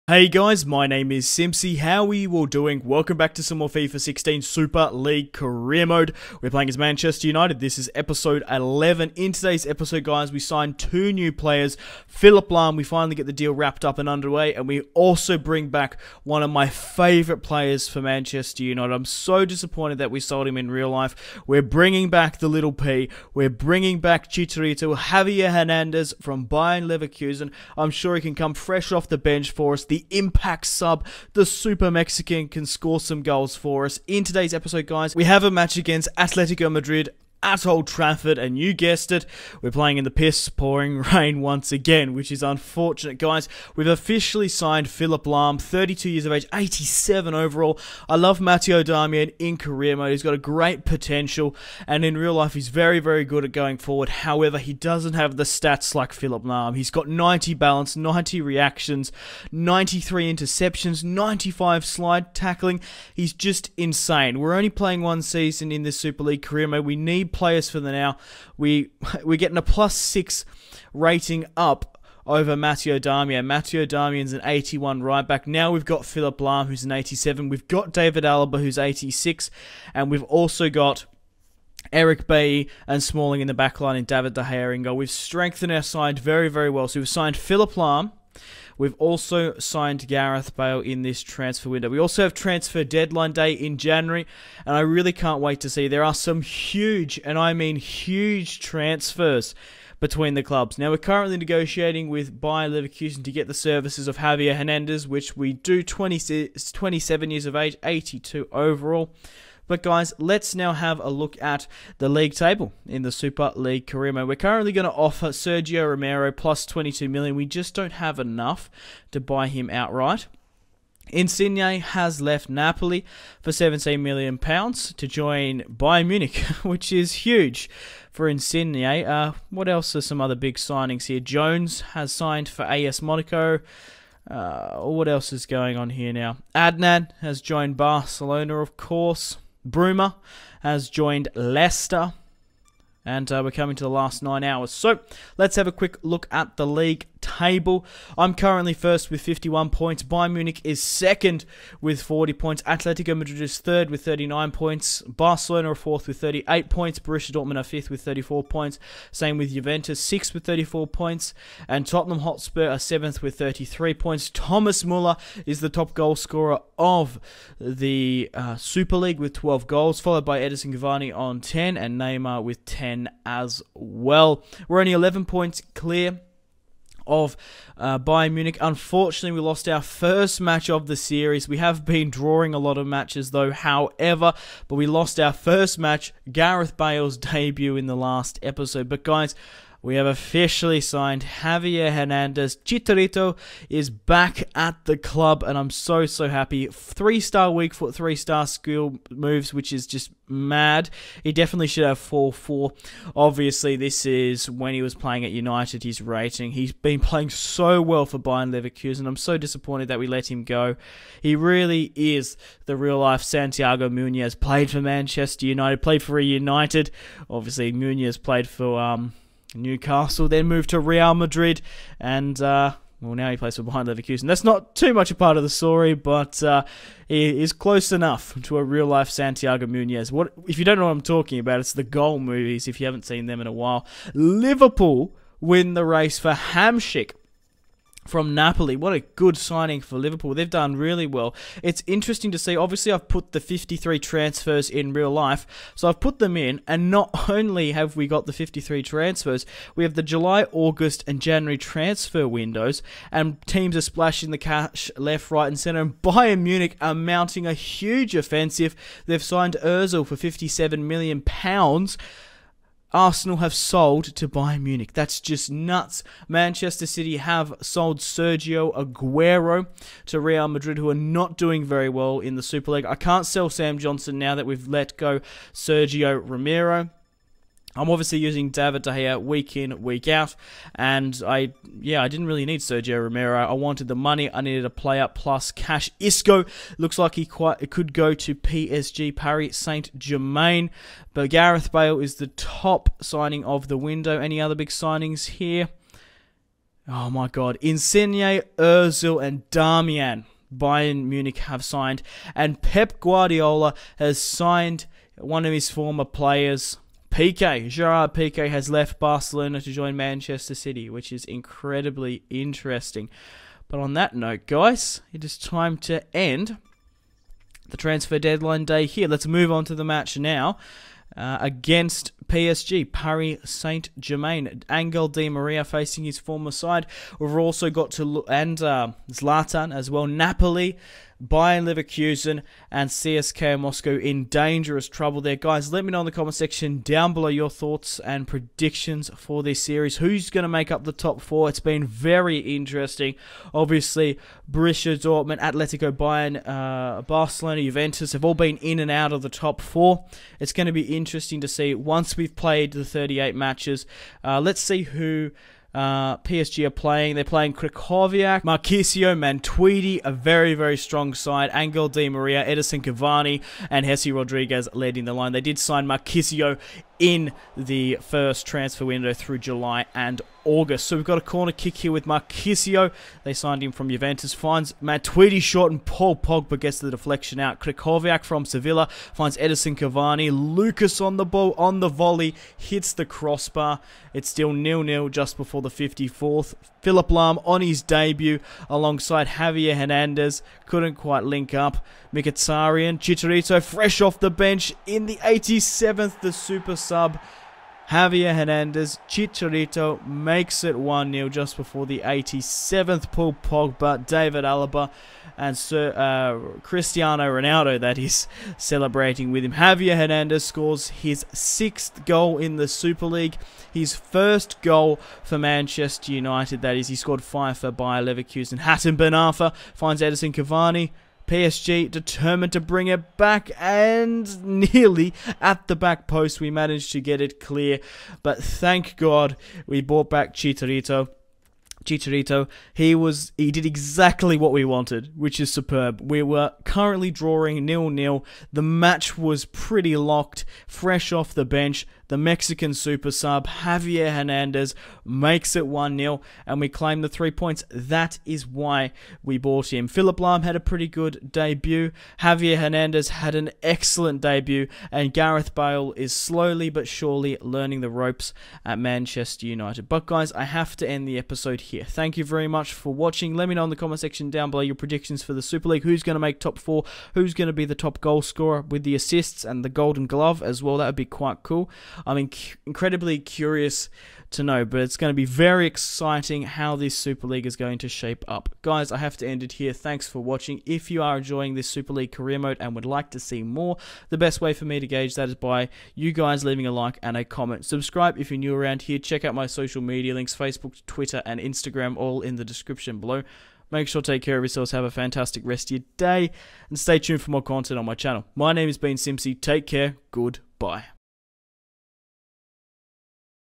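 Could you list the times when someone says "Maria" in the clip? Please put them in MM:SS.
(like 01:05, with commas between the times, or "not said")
05:25, 06:02.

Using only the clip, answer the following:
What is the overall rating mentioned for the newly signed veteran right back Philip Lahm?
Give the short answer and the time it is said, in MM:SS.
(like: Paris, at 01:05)
87, at 00:46.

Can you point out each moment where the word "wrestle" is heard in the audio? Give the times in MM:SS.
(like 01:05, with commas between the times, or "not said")
not said.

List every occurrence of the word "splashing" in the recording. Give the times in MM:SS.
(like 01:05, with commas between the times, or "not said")
04:13.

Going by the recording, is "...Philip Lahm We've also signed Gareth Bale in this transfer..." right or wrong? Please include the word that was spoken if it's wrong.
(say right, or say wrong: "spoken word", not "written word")
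right.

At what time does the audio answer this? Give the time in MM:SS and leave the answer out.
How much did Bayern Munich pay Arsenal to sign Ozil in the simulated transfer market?
04:20.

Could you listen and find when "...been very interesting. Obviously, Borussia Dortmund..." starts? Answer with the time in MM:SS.
05:41.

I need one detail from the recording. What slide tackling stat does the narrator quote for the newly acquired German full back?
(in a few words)
95.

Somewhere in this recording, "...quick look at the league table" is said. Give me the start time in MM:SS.
02:25.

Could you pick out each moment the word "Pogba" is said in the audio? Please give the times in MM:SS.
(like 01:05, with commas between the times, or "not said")
06:16, 06:43.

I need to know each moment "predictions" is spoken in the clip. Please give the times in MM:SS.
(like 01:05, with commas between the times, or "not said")
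05:38, 07:44.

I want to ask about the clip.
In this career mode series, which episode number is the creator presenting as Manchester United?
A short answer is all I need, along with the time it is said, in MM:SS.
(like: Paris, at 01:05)
11, at 00:07.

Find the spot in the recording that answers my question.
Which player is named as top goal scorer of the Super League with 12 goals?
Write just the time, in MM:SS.
02:44.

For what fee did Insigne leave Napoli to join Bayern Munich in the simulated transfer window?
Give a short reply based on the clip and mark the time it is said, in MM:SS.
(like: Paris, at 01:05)
17 million pounds, at 02:03.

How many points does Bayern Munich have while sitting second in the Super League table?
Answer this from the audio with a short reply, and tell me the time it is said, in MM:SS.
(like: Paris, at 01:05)
40, at 02:32.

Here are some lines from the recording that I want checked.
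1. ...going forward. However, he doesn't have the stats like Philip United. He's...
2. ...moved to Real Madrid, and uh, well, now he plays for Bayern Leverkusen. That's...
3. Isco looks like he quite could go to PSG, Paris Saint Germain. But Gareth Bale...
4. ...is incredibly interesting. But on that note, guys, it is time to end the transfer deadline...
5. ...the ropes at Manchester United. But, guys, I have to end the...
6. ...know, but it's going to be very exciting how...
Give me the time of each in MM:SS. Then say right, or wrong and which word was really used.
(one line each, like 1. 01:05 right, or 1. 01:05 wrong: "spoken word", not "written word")
1. 00:53 wrong: "Lahm", not "United"
2. 03:40 right
3. 04:45 right
4. 05:11 right
5. 07:37 right
6. 07:54 right.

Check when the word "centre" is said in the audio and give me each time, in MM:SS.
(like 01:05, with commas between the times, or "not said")
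04:15.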